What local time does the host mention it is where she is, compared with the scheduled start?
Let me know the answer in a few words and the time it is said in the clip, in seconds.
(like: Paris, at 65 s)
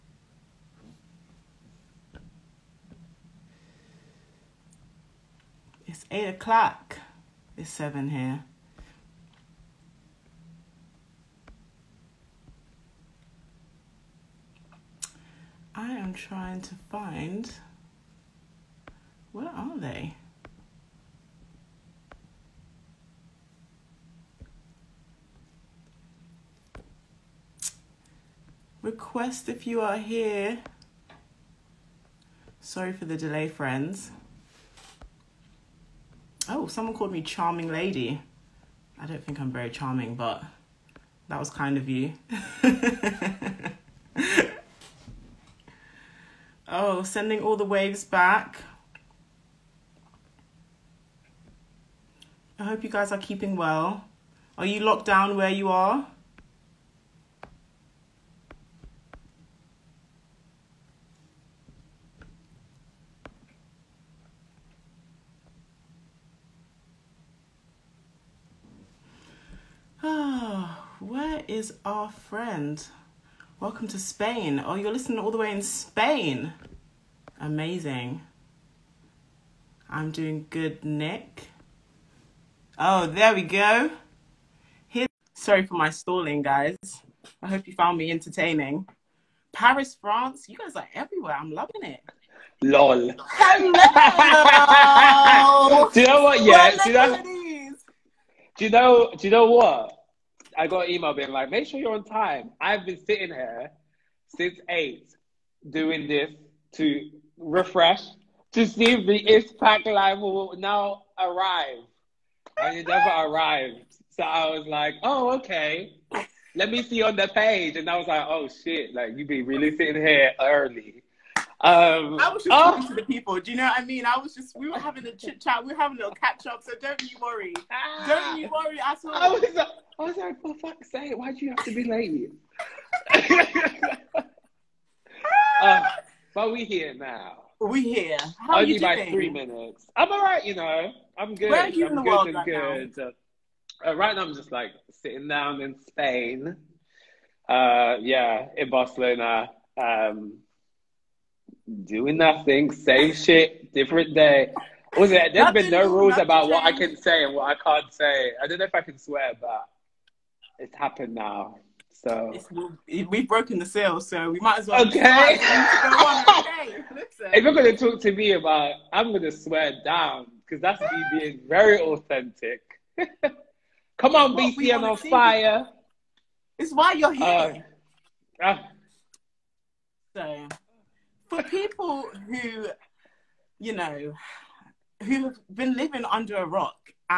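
7, at 7 s.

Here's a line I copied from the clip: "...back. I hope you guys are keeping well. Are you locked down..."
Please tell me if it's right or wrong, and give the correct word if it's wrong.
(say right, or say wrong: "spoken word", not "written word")
right.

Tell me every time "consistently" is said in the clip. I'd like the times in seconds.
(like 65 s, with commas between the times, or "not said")
not said.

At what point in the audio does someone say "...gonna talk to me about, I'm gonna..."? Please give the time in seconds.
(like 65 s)
167 s.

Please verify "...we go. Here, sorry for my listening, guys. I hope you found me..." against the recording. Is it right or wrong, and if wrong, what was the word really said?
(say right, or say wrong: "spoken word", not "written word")
wrong: "stalling", not "listening".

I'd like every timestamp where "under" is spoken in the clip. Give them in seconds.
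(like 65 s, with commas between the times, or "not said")
186 s.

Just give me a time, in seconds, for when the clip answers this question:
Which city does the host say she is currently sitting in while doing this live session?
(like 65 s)
148 s.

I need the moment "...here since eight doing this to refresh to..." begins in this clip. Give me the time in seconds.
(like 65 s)
103 s.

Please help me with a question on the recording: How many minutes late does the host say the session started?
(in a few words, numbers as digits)
3.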